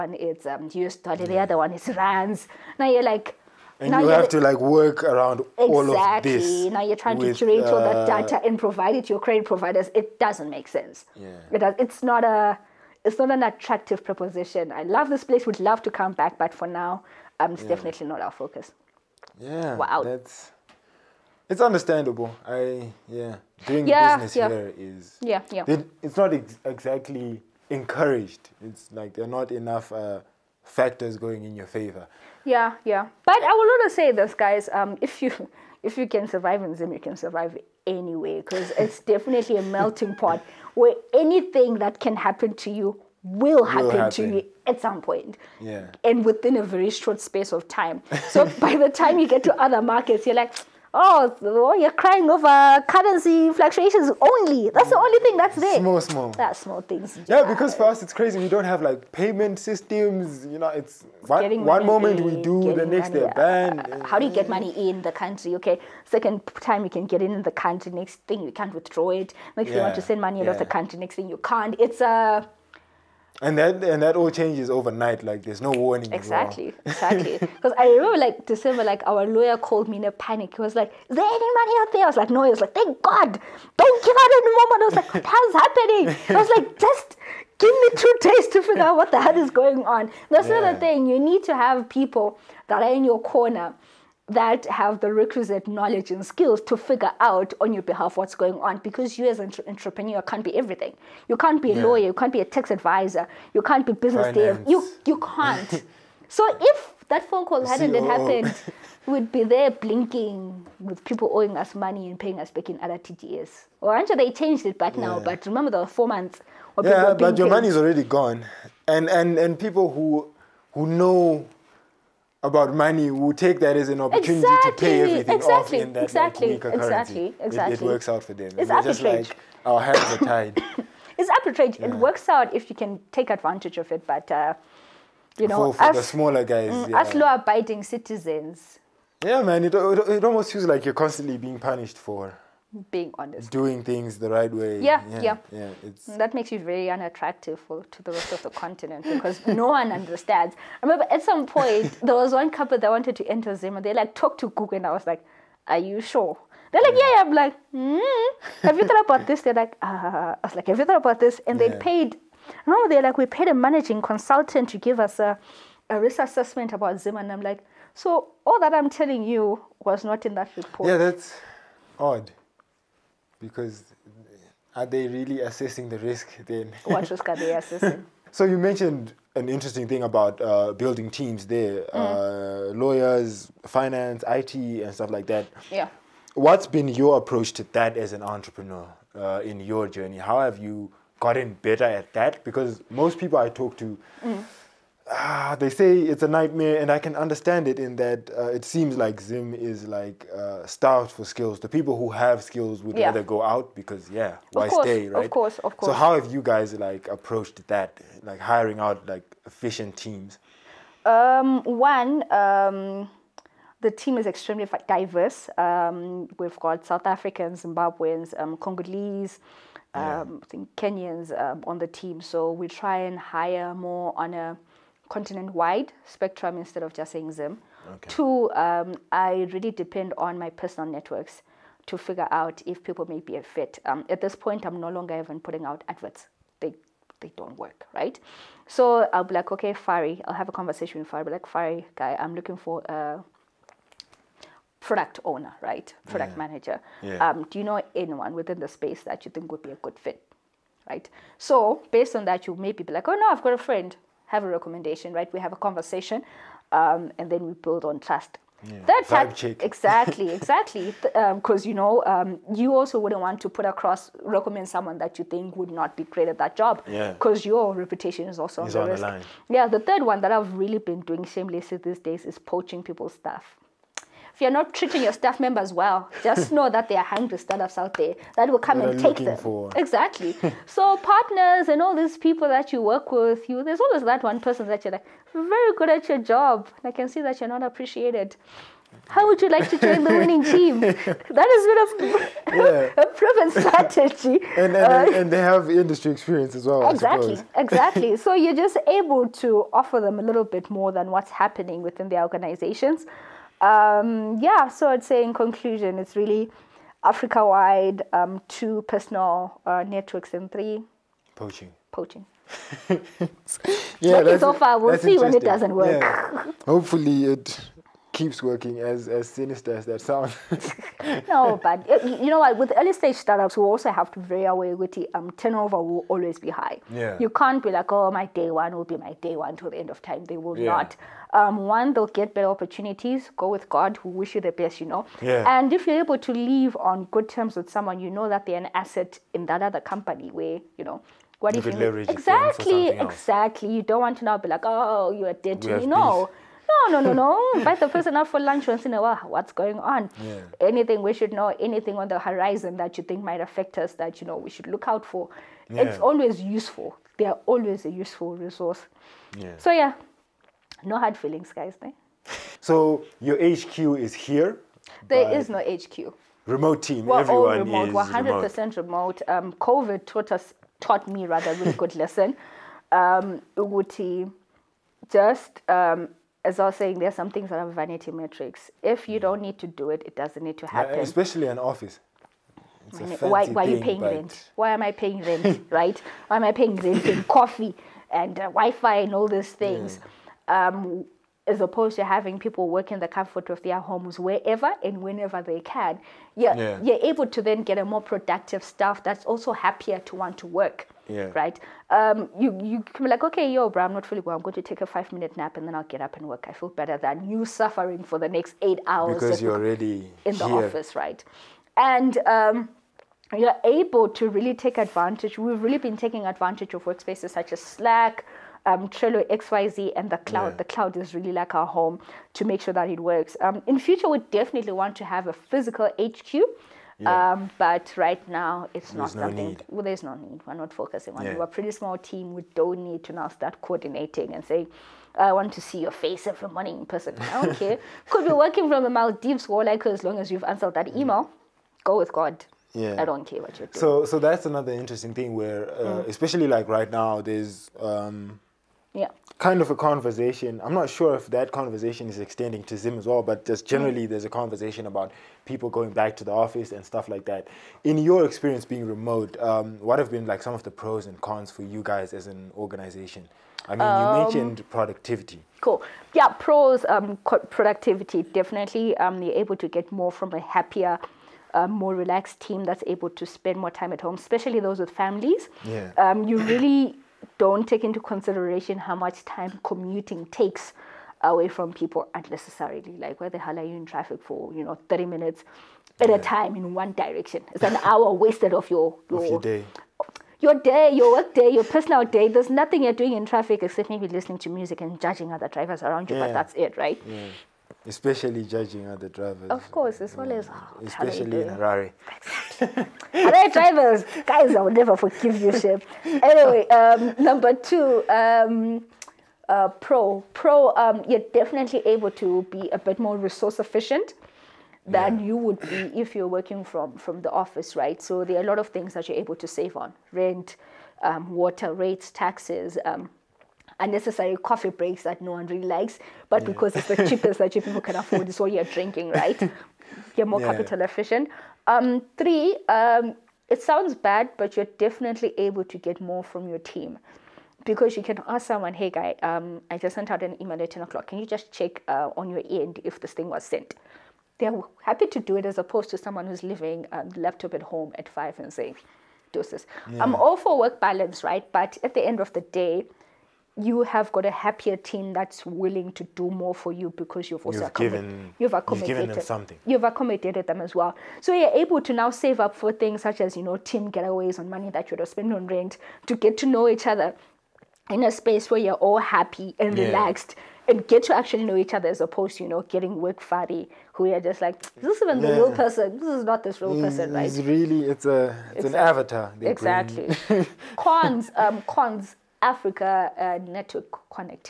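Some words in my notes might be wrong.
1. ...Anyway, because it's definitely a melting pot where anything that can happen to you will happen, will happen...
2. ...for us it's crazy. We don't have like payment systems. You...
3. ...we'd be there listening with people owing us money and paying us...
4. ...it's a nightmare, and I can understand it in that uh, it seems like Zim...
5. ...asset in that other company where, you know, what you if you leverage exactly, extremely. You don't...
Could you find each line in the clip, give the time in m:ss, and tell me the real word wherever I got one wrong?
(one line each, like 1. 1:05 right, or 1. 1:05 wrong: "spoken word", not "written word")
1. 0:37 right
2. 0:57 right
3. 1:49 wrong: "blinking", not "listening"
4. 3:15 right
5. 5:38 wrong: "exactly", not "extremely".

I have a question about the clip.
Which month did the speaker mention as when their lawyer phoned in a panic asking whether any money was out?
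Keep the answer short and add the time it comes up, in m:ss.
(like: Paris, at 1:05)
December, at 1:18.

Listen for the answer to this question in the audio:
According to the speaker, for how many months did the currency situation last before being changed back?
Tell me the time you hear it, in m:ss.
1:55.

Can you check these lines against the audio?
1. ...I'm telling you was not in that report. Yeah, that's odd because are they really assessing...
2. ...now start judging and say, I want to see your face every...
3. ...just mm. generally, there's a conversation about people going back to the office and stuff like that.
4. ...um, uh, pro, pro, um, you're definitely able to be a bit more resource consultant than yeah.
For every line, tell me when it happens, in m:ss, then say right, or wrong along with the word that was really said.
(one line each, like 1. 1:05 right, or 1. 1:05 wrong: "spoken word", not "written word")
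1. 2:48 right
2. 7:13 wrong: "coordinating", not "judging"
3. 7:33 right
4. 8:28 wrong: "efficient", not "consultant".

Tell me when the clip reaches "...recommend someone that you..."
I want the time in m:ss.
4:24.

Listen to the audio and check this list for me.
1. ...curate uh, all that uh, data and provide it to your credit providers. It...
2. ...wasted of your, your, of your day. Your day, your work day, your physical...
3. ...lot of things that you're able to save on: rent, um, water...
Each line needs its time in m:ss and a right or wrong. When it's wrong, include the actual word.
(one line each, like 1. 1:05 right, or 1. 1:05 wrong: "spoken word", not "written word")
1. 0:07 right
2. 8:08 wrong: "personal", not "physical"
3. 8:38 right.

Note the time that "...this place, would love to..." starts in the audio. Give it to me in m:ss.
0:15.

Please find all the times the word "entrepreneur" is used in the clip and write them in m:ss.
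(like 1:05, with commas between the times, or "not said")
1:39, 3:08.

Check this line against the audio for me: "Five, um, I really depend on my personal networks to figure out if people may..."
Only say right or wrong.
wrong.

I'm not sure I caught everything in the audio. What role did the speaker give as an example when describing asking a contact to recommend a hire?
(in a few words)
Product owner.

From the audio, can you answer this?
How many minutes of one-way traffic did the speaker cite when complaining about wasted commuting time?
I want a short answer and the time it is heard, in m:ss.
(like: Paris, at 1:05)
30, at 8:04.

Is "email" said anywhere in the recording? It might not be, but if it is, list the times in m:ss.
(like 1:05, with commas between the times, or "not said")
7:20, 9:00.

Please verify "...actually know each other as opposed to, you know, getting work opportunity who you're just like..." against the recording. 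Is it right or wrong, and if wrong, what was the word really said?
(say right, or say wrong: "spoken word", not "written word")
wrong: "fatty", not "opportunity".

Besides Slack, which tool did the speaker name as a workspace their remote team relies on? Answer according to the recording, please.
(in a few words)
Trello.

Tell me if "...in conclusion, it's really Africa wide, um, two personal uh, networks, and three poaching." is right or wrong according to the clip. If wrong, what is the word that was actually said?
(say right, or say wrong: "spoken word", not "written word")
right.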